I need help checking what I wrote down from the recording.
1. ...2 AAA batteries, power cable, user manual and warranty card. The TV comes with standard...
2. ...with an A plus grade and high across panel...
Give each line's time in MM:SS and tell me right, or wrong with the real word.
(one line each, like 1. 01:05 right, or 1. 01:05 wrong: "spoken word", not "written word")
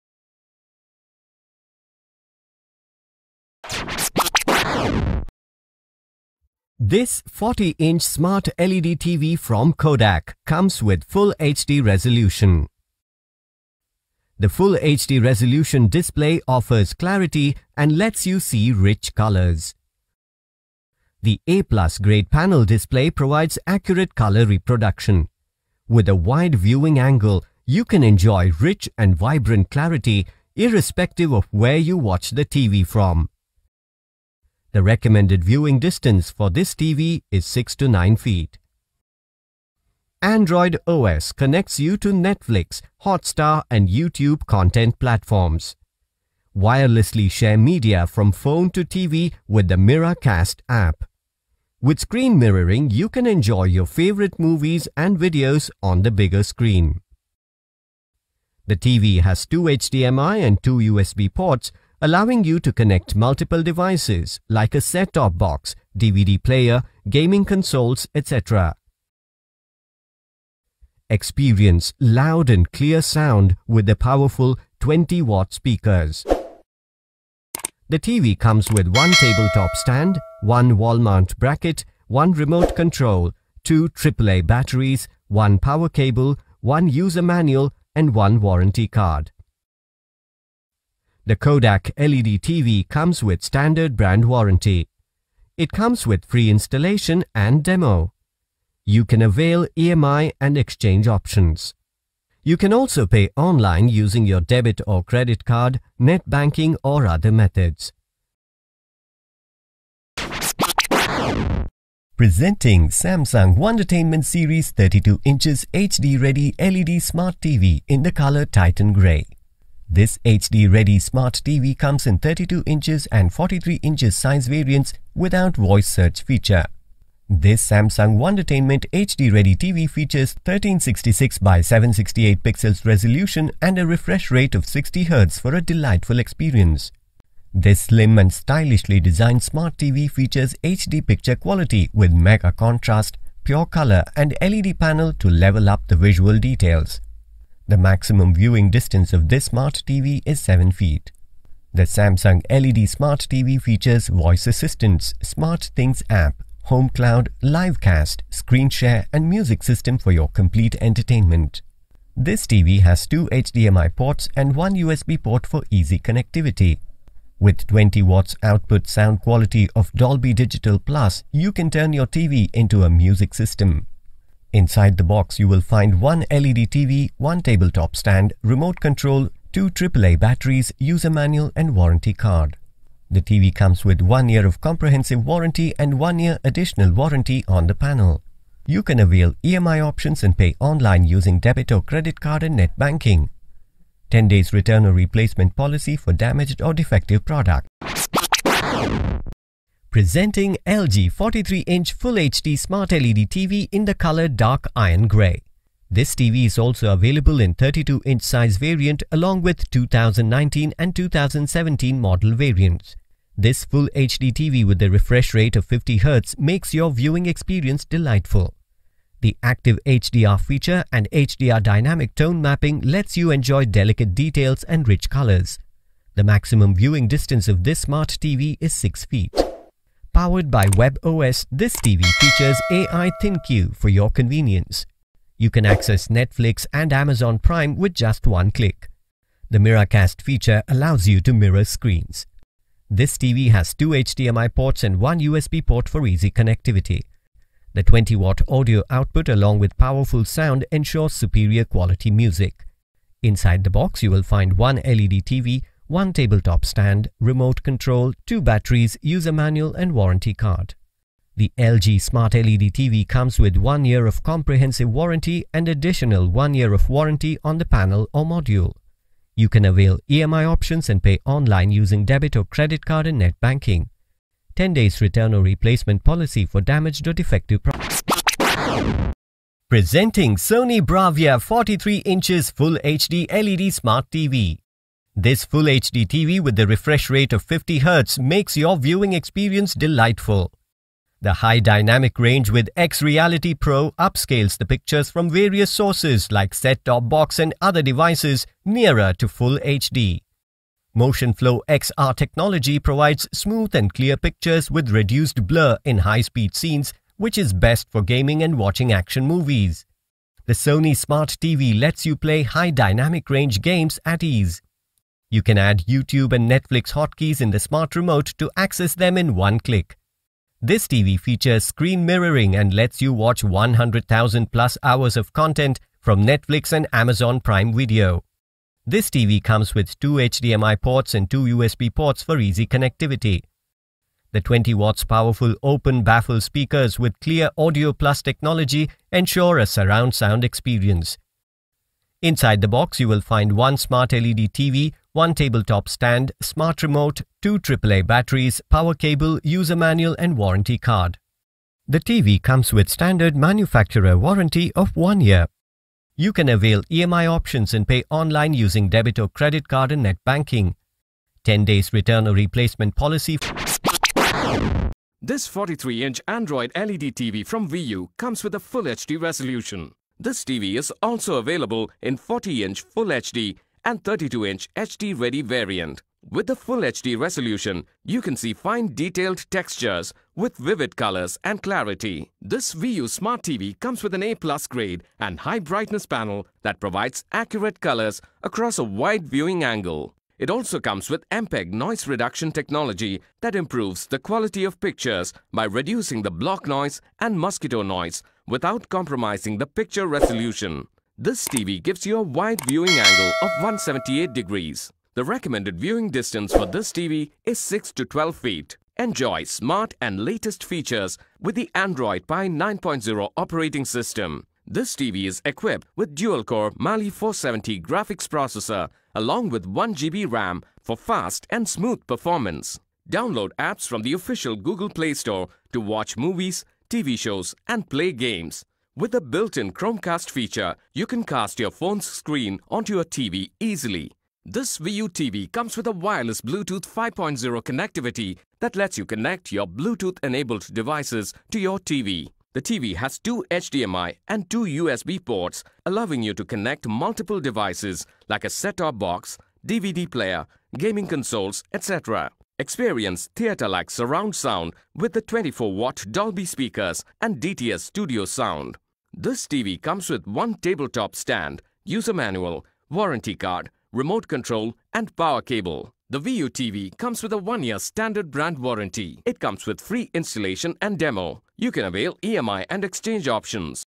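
1. 05:47 right
2. 06:24 wrong: "brightness", not "across".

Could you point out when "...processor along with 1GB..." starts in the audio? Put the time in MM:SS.
06:58.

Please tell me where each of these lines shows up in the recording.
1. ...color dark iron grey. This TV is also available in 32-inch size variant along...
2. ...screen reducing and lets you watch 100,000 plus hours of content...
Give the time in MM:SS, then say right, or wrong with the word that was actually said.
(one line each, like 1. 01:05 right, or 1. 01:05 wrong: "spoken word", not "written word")
1. 03:23 right
2. 05:21 wrong: "mirroring", not "reducing".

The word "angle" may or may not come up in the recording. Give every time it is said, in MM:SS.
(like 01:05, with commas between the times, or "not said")
00:26, 06:29, 06:42.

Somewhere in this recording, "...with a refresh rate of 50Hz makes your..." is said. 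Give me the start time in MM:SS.
03:34.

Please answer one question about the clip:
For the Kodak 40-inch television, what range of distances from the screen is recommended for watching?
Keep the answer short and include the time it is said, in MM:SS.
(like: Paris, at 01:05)
6 to 9 feet, at 00:37.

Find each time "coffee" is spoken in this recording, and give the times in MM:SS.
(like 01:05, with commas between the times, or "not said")
not said.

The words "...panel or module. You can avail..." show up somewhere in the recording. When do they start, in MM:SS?
04:27.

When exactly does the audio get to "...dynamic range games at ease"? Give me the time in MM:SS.
05:12.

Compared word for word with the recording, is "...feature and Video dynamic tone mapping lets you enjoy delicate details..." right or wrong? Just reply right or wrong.
wrong.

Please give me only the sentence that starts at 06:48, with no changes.
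Enjoy smart and latest features with the Android Pie 9.0 operating system.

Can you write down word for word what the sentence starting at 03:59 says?
The Miracast feature allows you to mirror screens.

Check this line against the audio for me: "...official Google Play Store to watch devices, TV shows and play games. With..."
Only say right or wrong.
wrong.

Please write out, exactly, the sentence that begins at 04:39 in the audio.
Presenting Sony Bravia 43 inches Full HD LED Smart TV.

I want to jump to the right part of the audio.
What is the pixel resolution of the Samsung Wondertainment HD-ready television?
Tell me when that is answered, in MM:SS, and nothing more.
02:10.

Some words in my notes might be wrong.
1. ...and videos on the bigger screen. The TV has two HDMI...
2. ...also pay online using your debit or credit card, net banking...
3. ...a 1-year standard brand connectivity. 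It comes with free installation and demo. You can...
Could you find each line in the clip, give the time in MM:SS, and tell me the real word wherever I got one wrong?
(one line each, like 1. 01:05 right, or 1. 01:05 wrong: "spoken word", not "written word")
1. 00:54 right
2. 01:42 right
3. 07:47 wrong: "warranty", not "connectivity".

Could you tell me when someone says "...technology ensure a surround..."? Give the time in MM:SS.
05:38.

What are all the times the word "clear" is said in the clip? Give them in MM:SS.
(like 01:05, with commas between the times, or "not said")
01:12, 05:03, 05:37.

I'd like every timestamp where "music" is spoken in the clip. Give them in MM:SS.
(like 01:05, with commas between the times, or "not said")
02:39, 02:52, 04:12.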